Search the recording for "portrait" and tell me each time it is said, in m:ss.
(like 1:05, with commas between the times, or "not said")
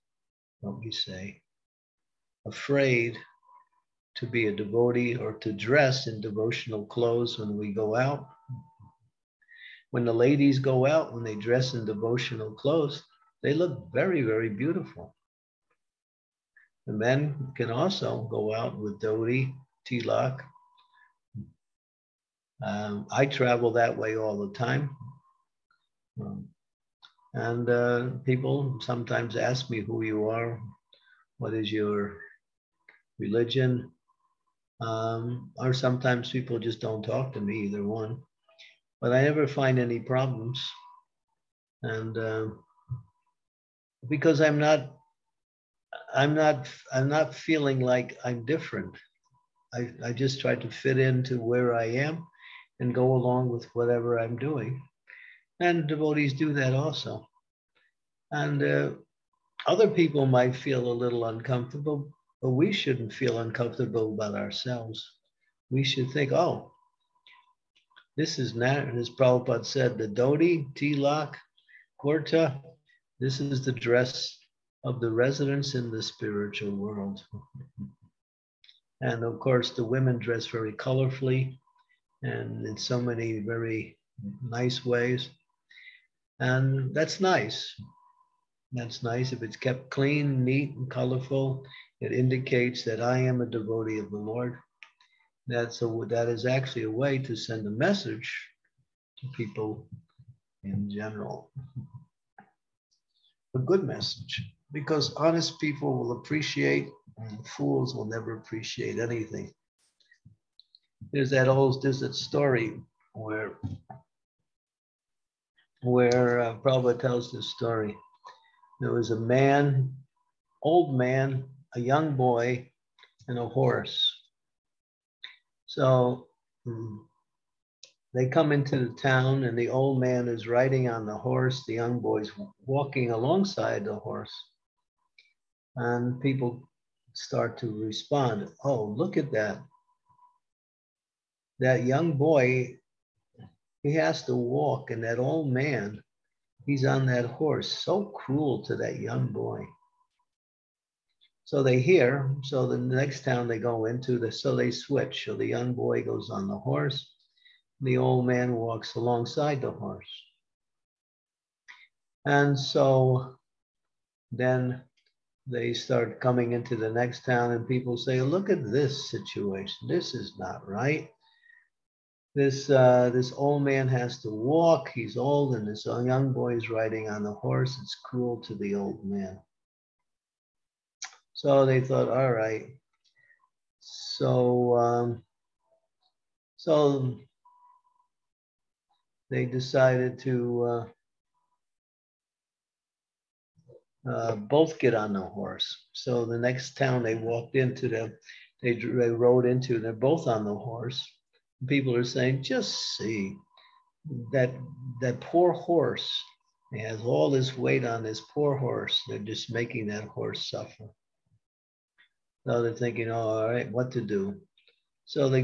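not said.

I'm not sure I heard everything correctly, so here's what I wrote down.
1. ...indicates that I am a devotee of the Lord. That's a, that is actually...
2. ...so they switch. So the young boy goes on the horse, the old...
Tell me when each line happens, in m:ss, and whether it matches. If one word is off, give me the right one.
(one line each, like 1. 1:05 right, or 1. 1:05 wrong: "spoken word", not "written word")
1. 1:32 right
2. 2:34 right.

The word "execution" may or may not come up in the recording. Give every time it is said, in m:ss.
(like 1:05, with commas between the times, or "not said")
not said.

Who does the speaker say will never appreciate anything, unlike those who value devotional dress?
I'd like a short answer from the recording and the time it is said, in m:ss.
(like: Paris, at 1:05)
Fools, at 1:47.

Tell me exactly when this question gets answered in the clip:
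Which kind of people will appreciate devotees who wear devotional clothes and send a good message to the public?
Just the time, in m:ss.
1:45.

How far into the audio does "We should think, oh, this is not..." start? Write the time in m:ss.
1:05.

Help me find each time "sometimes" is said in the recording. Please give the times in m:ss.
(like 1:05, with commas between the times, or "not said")
0:28, 0:35.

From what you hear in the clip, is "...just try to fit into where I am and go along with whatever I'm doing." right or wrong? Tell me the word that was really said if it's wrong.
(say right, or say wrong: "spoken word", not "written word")
right.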